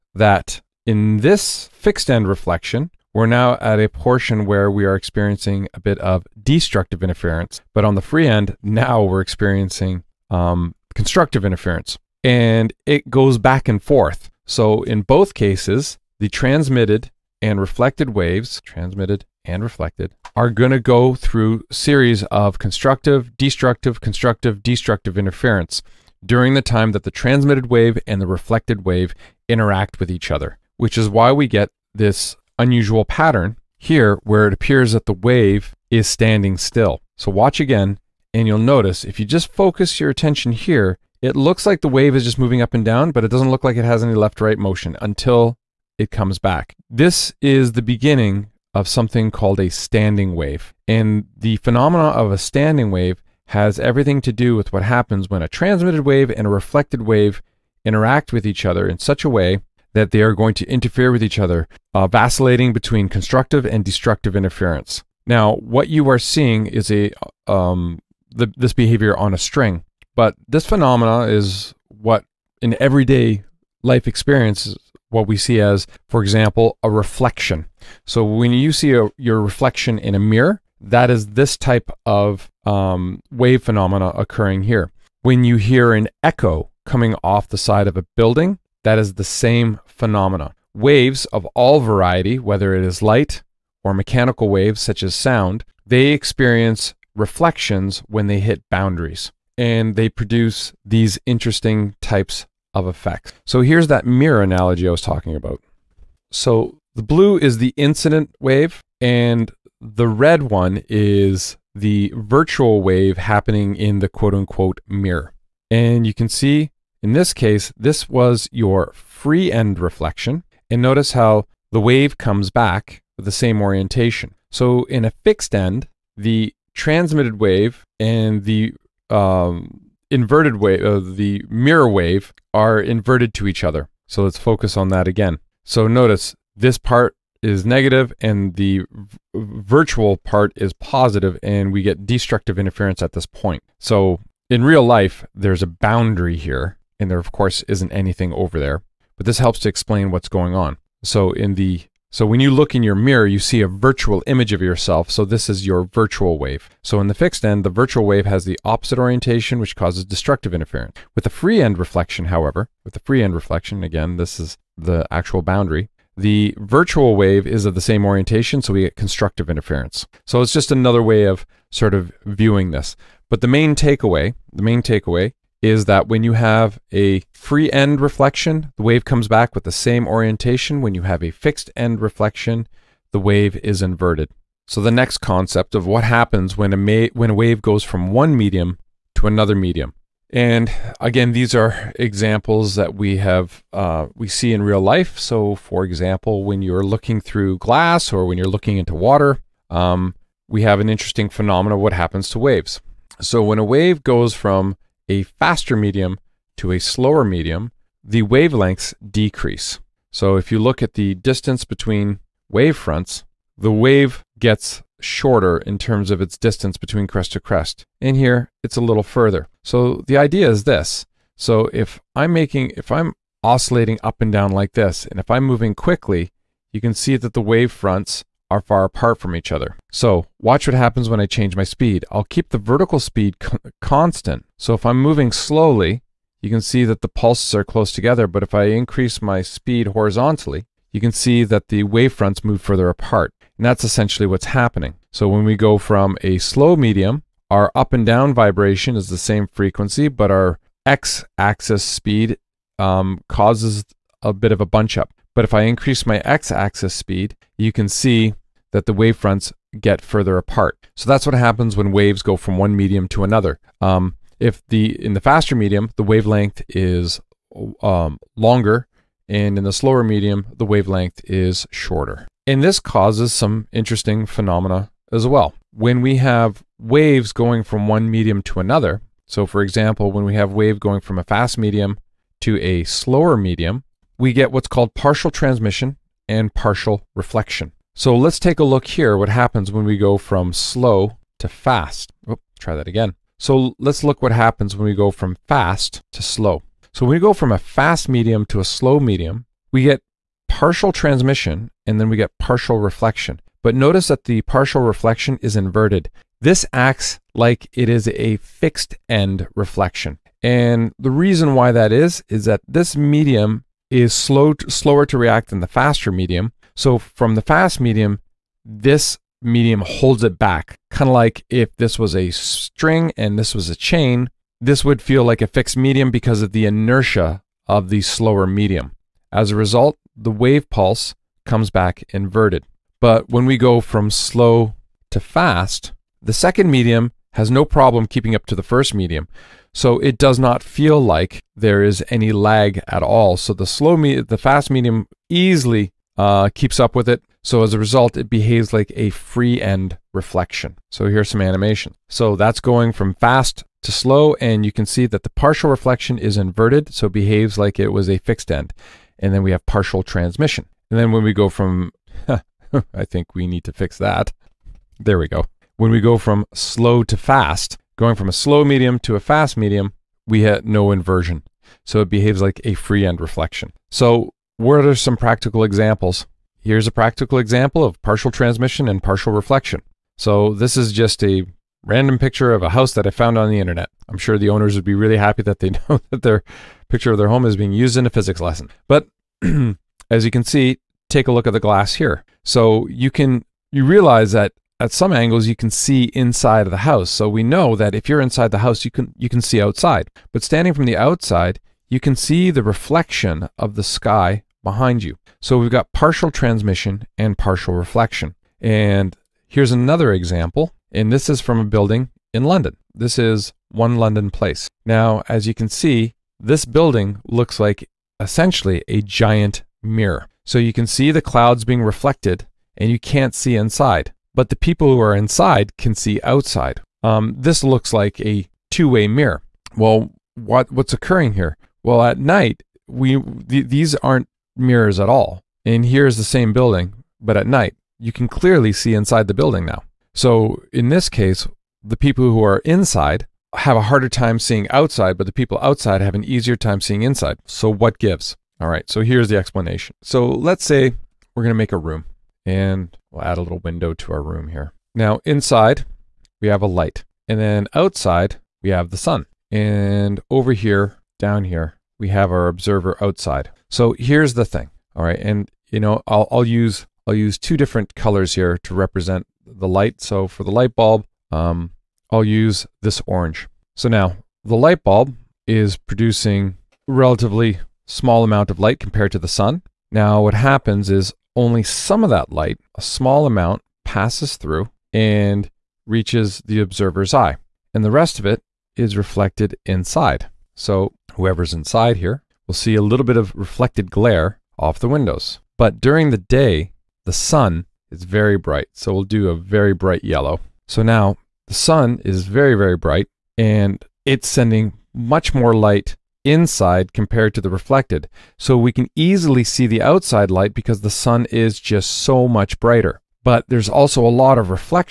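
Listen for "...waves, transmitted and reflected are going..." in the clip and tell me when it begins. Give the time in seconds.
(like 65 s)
18 s.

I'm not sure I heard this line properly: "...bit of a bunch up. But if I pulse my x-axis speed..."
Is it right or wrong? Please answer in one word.
wrong.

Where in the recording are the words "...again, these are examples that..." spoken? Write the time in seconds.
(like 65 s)
191 s.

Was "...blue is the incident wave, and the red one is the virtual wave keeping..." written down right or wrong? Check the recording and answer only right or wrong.
wrong.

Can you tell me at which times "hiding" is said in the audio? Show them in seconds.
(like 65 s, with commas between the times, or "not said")
not said.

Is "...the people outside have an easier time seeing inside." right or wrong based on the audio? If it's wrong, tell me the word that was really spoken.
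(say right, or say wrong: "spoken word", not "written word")
right.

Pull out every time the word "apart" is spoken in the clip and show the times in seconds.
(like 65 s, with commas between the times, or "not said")
228 s, 242 s, 260 s.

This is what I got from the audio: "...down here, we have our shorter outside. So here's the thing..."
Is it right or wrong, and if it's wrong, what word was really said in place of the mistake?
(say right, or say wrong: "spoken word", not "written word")
wrong: "observer", not "shorter".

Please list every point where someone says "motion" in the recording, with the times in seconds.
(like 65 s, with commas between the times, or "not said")
44 s.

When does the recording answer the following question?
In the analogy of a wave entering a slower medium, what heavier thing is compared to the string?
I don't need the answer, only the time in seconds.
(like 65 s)
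323 s.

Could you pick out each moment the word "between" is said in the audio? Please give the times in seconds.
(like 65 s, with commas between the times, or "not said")
62 s, 211 s, 216 s.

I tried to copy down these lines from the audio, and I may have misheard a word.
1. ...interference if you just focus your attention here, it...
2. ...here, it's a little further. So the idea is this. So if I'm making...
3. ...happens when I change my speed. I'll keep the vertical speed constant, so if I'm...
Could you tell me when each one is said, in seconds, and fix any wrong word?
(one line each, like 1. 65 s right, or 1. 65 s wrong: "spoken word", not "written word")
1. 38 s wrong: "notice", not "interference"
2. 218 s right
3. 230 s right.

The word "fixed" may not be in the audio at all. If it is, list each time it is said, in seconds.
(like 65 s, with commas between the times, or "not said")
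1 s, 125 s, 157 s, 181 s, 308 s, 325 s, 358 s.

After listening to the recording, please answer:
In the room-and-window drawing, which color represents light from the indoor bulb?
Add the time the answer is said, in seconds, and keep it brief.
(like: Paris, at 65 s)
orange, at 473 s.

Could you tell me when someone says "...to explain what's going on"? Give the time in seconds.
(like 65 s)
149 s.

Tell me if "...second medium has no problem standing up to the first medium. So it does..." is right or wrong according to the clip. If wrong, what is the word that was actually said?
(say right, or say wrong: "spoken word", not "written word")
wrong: "keeping", not "standing".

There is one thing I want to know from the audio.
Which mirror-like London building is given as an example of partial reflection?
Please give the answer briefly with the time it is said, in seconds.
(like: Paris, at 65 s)
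One London Place, at 413 s.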